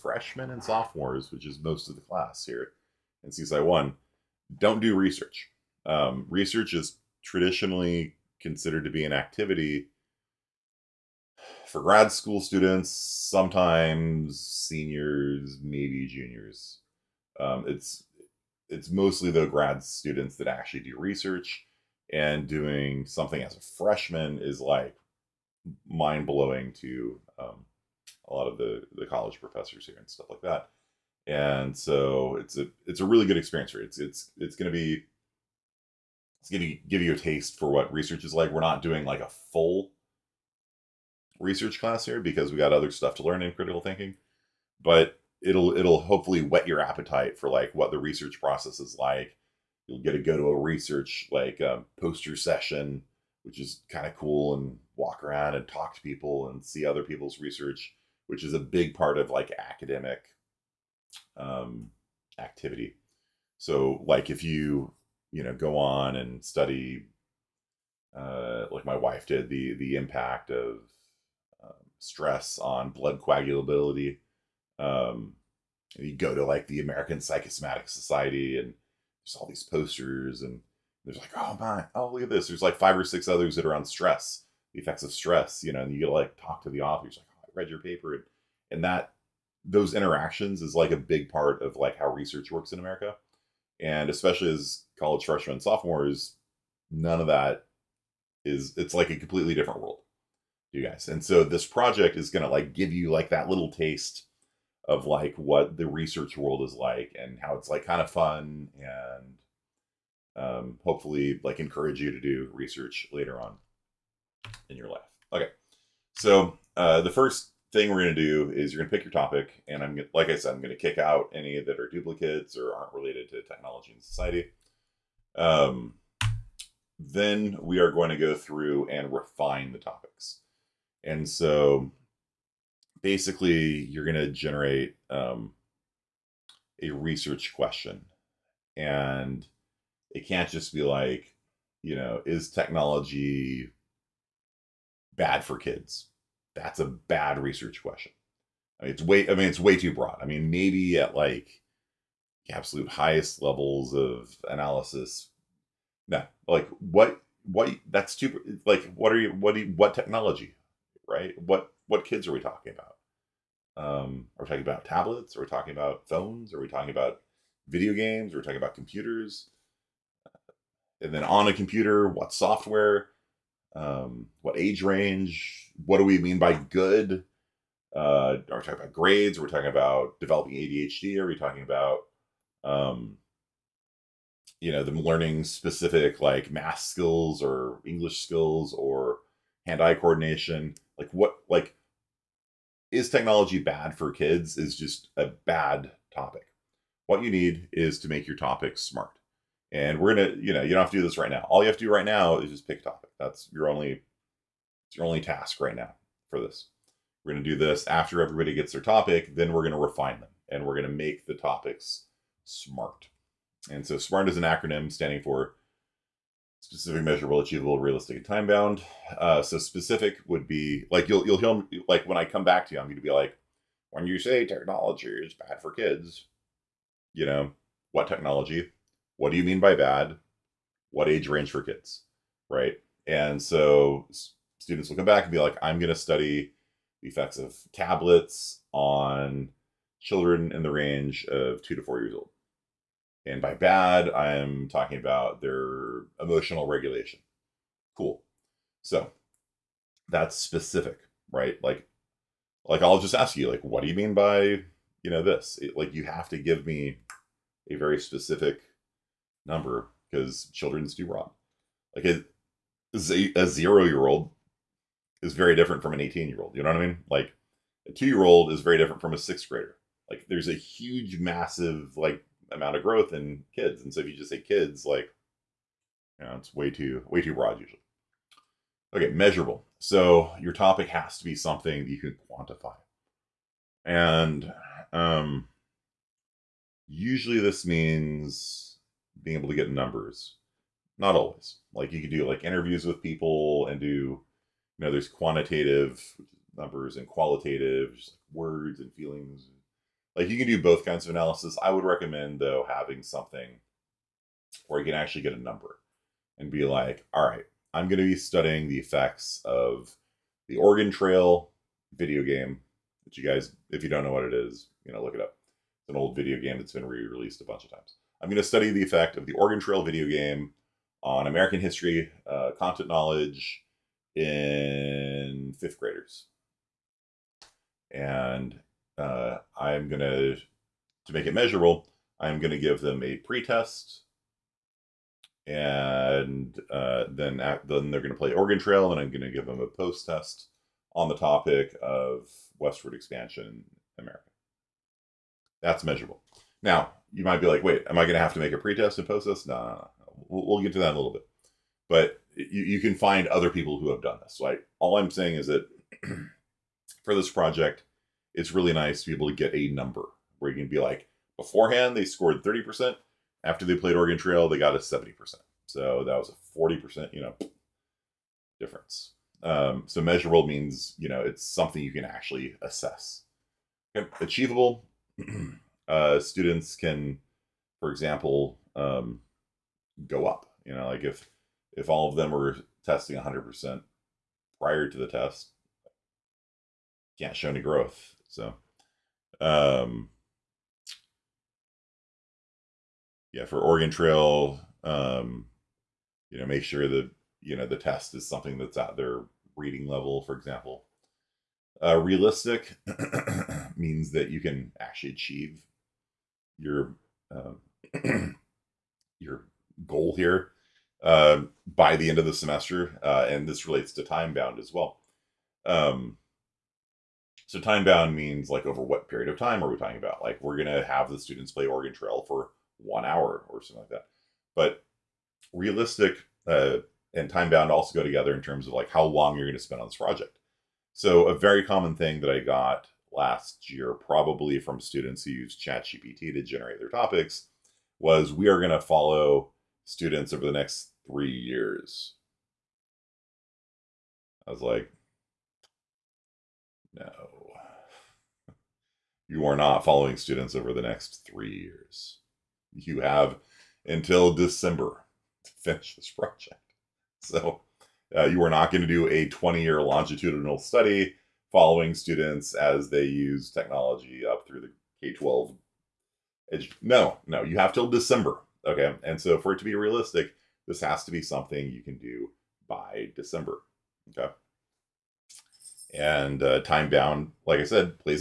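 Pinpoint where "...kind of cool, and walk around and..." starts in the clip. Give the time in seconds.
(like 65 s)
53 s.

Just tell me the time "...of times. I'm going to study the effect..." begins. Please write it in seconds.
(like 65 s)
317 s.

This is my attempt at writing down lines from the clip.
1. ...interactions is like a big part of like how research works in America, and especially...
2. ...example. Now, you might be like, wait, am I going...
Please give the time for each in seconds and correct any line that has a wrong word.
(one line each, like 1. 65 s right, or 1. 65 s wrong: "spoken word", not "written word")
1. 89 s right
2. 345 s wrong: "measurable", not "example".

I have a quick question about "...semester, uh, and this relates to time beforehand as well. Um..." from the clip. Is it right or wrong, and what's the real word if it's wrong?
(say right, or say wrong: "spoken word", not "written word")
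wrong: "bound", not "beforehand".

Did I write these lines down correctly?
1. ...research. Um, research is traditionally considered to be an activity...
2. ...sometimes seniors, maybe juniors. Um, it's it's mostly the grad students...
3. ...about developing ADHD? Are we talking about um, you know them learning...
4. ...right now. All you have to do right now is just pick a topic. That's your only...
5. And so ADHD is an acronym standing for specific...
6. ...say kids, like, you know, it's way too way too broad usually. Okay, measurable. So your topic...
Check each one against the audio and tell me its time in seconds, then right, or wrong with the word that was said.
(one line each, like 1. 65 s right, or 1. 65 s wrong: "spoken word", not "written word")
1. 4 s right
2. 12 s right
3. 179 s right
4. 201 s right
5. 213 s wrong: "SMART", not "ADHD"
6. 274 s right.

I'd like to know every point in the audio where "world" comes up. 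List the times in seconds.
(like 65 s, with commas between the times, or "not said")
99 s, 106 s.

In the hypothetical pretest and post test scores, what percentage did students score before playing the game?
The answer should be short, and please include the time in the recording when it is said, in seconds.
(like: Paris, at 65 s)
30%, at 362 s.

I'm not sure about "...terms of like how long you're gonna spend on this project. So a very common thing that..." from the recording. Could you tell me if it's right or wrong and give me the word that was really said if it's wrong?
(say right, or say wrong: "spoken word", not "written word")
right.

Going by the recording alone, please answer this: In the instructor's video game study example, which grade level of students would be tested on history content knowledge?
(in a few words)
fifth graders.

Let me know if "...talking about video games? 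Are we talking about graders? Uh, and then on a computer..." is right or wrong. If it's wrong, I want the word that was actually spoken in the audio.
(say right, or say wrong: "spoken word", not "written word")
wrong: "computers", not "graders".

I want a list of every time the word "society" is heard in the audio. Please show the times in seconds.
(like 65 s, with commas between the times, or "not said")
77 s, 124 s.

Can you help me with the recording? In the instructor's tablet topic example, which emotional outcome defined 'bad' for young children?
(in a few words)
emotional regulation.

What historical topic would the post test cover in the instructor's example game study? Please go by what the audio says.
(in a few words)
westward expansion.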